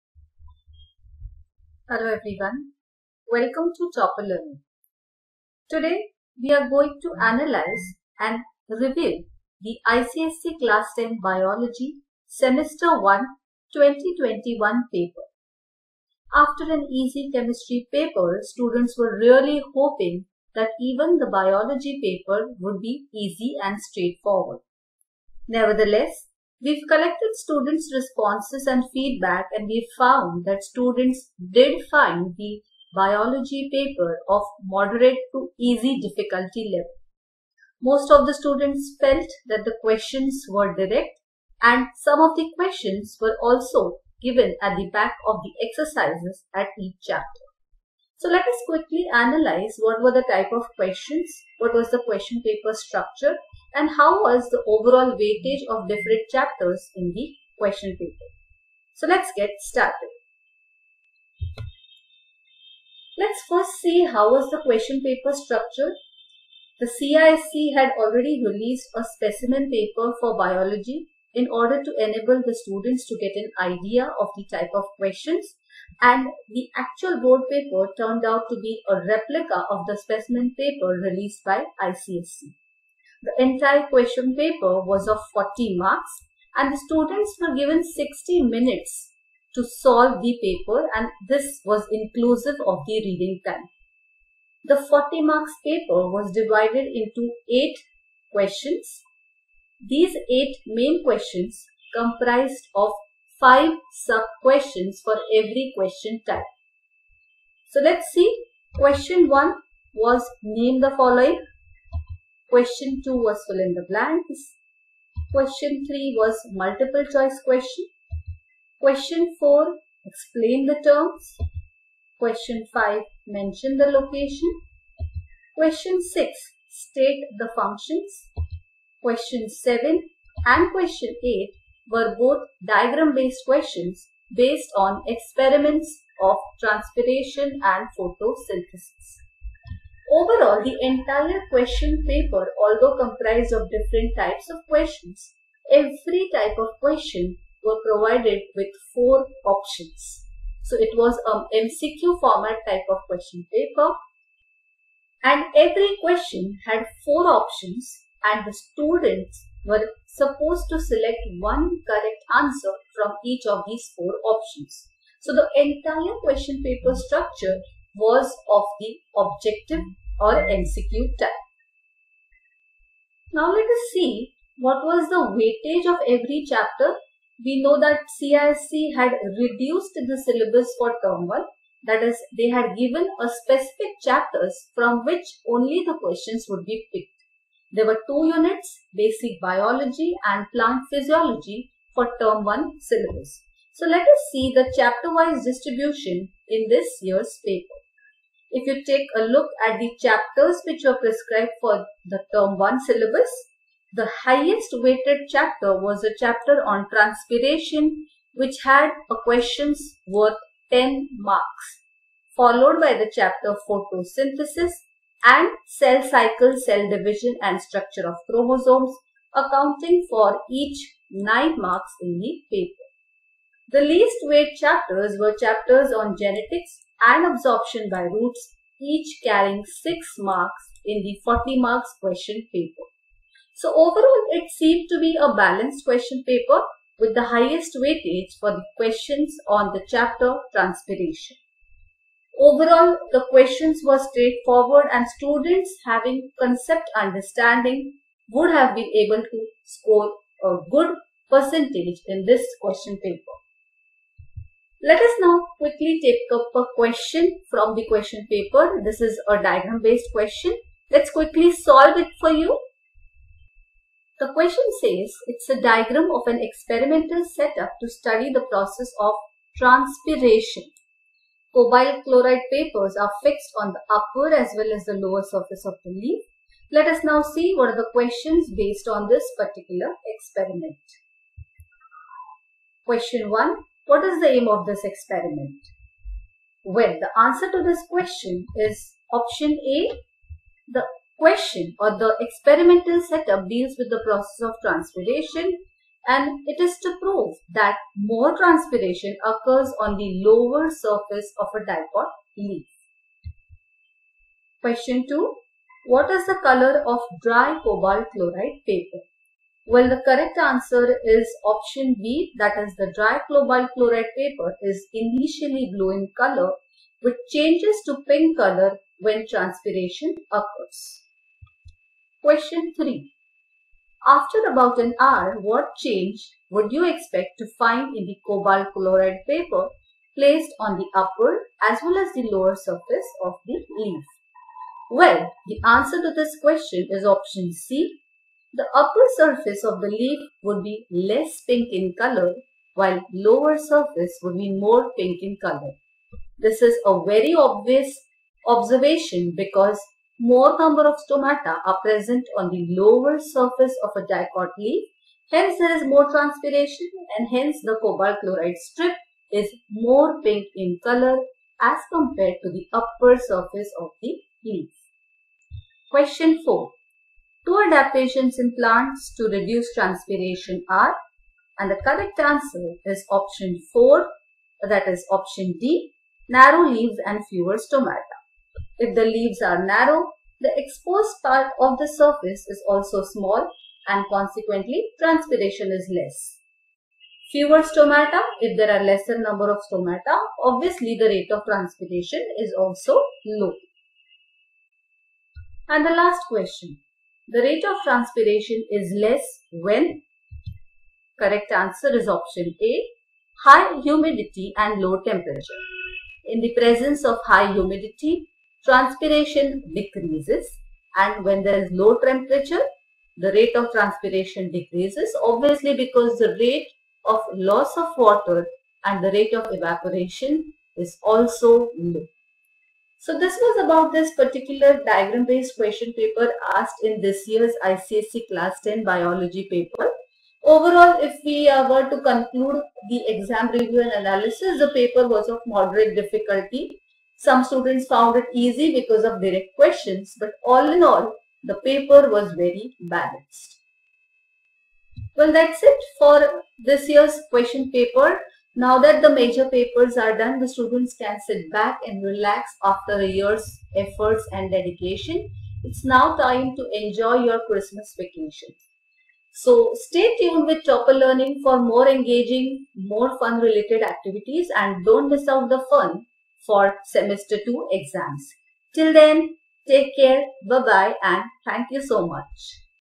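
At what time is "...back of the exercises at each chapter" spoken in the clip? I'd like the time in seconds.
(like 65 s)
44 s.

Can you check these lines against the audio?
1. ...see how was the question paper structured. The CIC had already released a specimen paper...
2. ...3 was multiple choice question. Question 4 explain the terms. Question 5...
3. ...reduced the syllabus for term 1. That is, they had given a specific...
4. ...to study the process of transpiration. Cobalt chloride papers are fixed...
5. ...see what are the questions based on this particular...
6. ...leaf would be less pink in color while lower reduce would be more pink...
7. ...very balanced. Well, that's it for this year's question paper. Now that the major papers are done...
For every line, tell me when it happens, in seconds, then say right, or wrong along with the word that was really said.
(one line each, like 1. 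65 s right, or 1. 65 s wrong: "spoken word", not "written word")
1. 63 s right
2. 115 s right
3. 179 s right
4. 267 s right
5. 277 s right
6. 339 s wrong: "surface", not "reduce"
7. 442 s right.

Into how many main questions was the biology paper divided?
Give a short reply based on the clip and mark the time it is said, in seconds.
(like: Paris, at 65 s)
8, at 97 s.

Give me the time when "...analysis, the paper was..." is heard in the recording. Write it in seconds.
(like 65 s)
433 s.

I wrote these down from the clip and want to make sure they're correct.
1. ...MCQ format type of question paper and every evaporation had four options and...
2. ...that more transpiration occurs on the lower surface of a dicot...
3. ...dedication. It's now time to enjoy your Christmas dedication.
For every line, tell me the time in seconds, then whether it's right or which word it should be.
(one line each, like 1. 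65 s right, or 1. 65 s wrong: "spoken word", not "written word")
1. 151 s wrong: "question", not "evaporation"
2. 297 s right
3. 454 s wrong: "vacation", not "dedication".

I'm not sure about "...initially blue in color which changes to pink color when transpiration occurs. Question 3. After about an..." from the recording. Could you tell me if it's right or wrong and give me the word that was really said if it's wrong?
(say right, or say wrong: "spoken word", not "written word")
right.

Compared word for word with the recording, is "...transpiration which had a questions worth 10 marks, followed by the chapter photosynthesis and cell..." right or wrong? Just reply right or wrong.
right.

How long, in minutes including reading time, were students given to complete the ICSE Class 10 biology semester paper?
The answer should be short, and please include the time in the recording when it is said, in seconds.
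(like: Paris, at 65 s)
60 minutes, at 87 s.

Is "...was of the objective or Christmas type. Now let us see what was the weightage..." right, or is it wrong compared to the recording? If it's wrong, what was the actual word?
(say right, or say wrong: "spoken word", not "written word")
wrong: "MCQ", not "Christmas".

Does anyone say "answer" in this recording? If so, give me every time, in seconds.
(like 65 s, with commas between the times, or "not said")
162 s, 287 s, 310 s, 335 s, 372 s, 401 s.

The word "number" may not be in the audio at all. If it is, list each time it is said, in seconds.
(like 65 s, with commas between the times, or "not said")
350 s, 389 s.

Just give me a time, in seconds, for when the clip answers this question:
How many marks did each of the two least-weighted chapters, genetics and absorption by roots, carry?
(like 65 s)
229 s.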